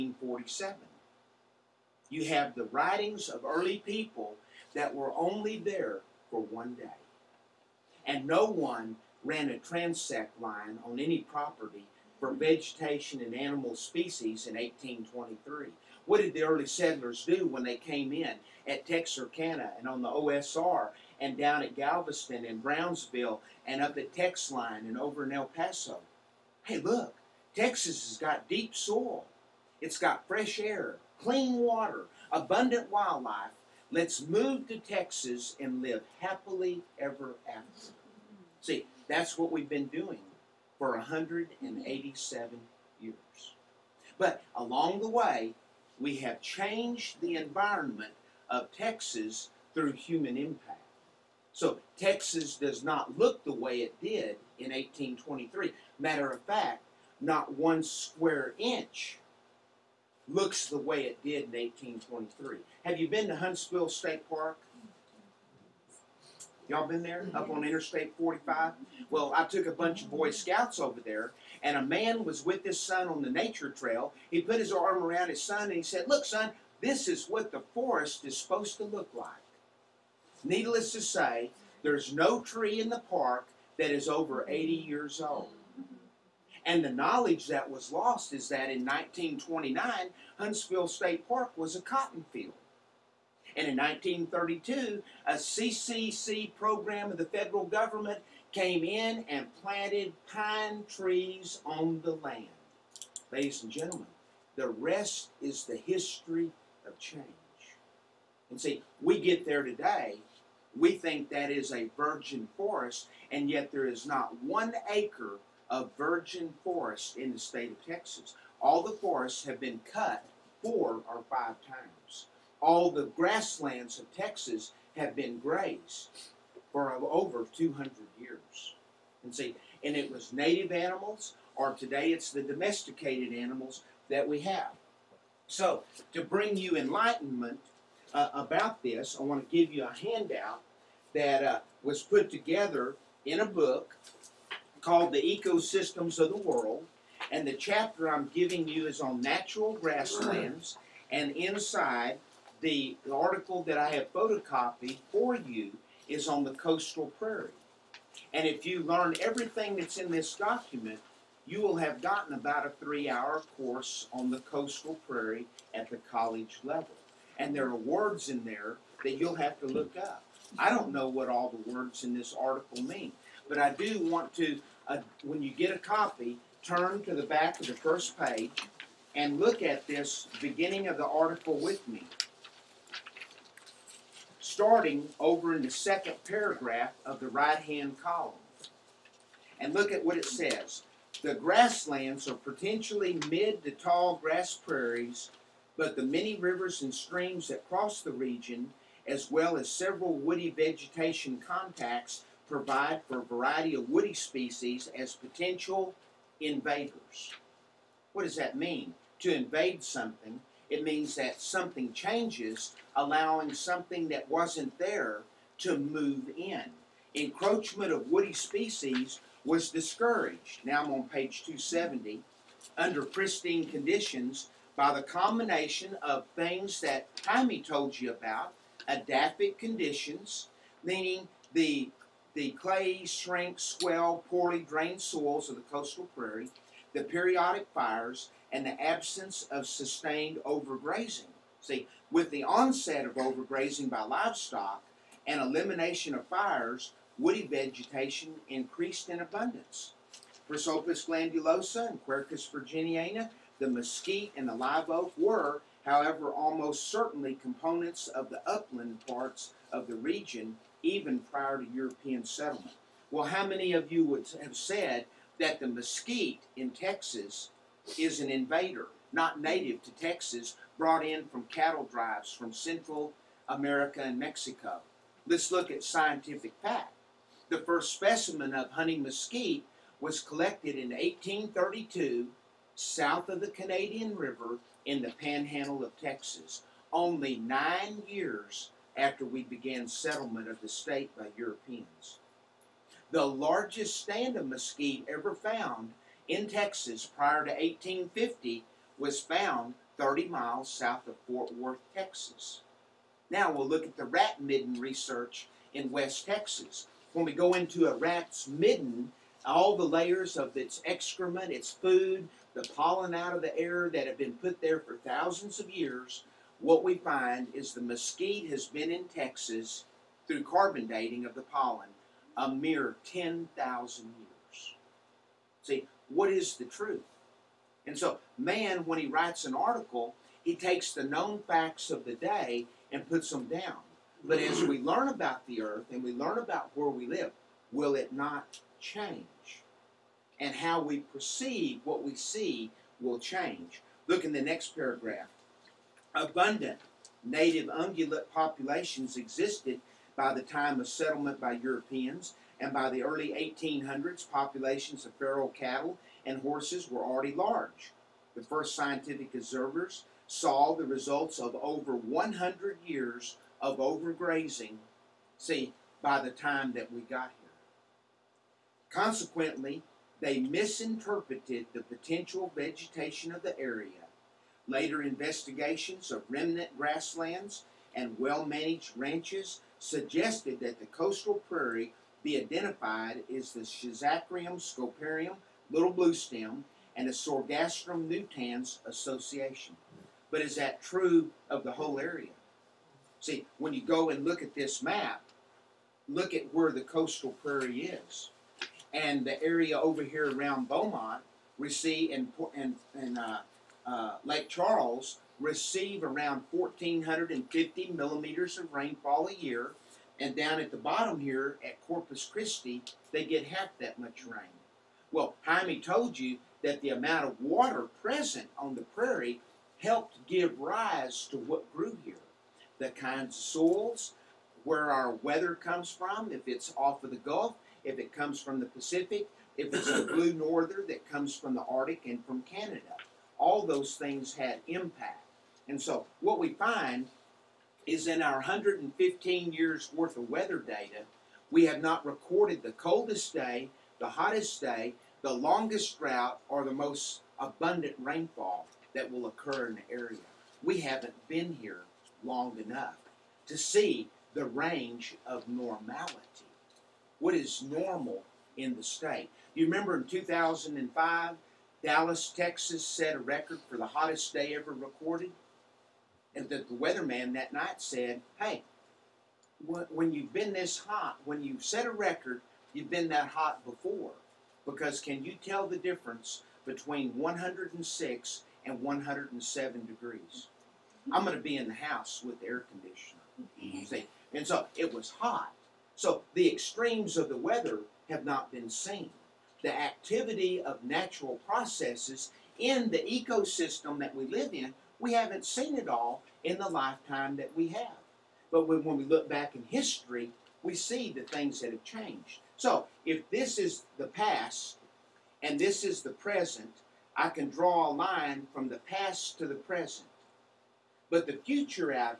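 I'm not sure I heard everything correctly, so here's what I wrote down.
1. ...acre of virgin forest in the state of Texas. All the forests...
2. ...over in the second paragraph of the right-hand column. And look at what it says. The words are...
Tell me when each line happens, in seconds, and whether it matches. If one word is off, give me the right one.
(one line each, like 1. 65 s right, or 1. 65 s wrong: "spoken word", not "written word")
1. 114 s right
2. 185 s wrong: "grasslands", not "words".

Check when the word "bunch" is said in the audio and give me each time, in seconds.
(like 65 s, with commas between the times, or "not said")
69 s.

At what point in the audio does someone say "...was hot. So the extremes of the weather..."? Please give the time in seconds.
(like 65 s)
484 s.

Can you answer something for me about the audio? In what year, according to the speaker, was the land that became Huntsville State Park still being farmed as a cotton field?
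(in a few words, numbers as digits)
1929.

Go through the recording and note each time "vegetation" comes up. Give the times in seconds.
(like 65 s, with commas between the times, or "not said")
12 s, 200 s, 247 s, 372 s.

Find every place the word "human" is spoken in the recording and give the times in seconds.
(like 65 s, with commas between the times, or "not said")
49 s.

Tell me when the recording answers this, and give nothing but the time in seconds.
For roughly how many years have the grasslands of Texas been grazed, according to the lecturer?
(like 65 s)
126 s.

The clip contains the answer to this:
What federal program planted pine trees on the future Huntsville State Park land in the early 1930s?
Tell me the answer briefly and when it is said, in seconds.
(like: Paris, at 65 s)
CCC, at 95 s.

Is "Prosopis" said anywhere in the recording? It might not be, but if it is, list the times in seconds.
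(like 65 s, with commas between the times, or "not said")
250 s.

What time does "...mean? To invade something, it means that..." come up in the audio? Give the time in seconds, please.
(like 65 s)
208 s.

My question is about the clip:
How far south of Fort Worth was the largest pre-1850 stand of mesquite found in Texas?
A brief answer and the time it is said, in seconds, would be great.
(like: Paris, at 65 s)
30 miles, at 299 s.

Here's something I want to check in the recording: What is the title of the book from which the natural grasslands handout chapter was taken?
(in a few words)
The Ecosystems of the World.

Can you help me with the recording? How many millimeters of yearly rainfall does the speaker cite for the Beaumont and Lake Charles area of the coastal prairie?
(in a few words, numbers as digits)
1,450 millimeters.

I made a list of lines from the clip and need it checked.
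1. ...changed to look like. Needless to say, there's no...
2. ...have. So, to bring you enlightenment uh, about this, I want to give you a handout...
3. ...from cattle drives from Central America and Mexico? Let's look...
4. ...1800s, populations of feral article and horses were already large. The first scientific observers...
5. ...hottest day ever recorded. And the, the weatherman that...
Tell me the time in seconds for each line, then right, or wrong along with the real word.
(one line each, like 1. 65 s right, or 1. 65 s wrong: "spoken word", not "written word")
1. 78 s wrong: "supposed", not "changed"
2. 134 s right
3. 271 s right
4. 353 s wrong: "cattle", not "article"
5. 463 s right.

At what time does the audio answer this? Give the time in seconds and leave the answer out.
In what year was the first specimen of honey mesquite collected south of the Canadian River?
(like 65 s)
280 s.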